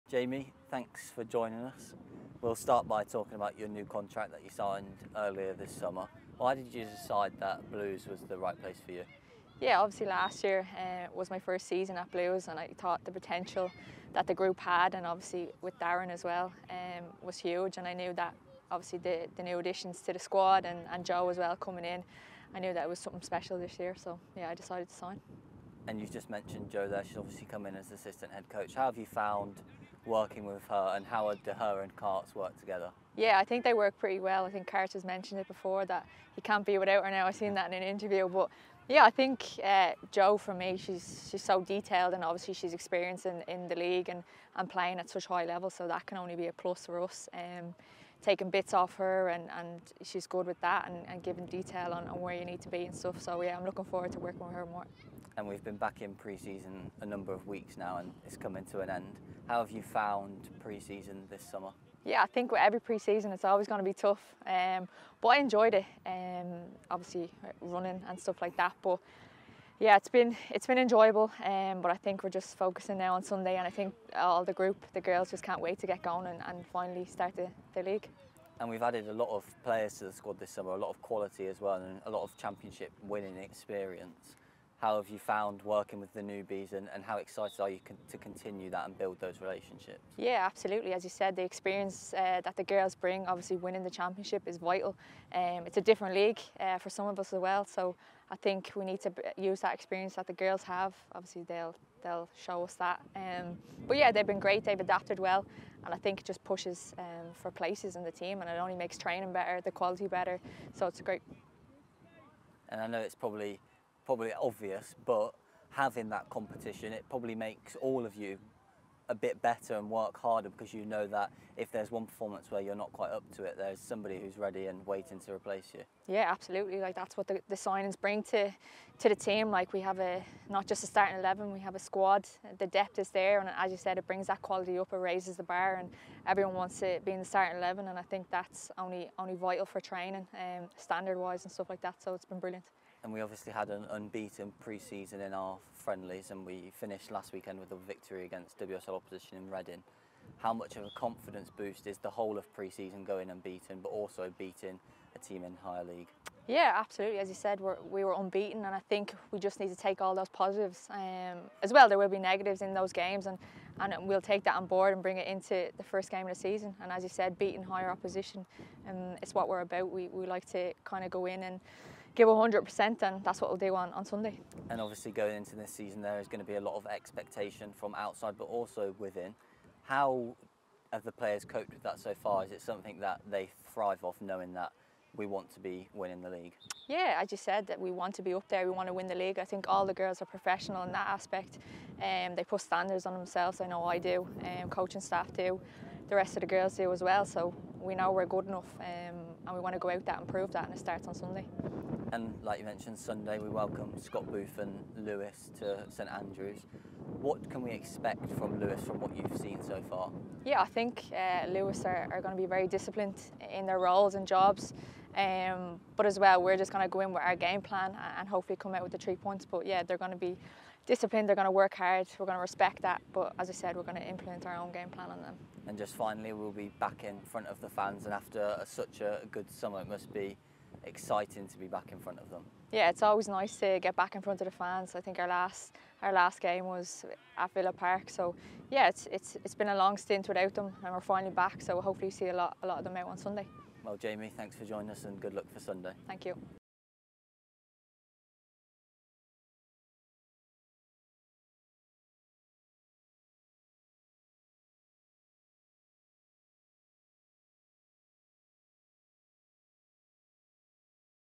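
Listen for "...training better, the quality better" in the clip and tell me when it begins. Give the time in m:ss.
1:48.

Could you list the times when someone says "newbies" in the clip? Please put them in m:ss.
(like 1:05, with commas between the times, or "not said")
1:26.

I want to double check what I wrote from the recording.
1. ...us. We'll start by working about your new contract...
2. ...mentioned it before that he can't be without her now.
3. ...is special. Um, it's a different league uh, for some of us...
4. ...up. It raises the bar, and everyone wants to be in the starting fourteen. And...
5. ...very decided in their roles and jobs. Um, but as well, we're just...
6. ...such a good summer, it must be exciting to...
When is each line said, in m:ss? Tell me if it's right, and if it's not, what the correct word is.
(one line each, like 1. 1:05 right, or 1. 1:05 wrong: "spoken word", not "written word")
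1. 0:01 wrong: "talking", not "working"
2. 0:35 right
3. 1:34 wrong: "vital", not "special"
4. 2:14 wrong: "eleven", not "fourteen"
5. 3:32 wrong: "disciplined", not "decided"
6. 3:48 right.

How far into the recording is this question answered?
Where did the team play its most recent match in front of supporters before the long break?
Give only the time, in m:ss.
3:57.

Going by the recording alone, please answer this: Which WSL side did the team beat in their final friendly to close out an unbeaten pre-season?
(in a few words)
Reading.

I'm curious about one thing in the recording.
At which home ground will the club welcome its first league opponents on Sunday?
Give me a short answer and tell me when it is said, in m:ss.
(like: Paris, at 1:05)
St Andrews, at 3:25.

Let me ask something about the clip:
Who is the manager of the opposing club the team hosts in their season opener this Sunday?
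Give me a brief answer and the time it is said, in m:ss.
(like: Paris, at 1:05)
Scott Booth, at 3:24.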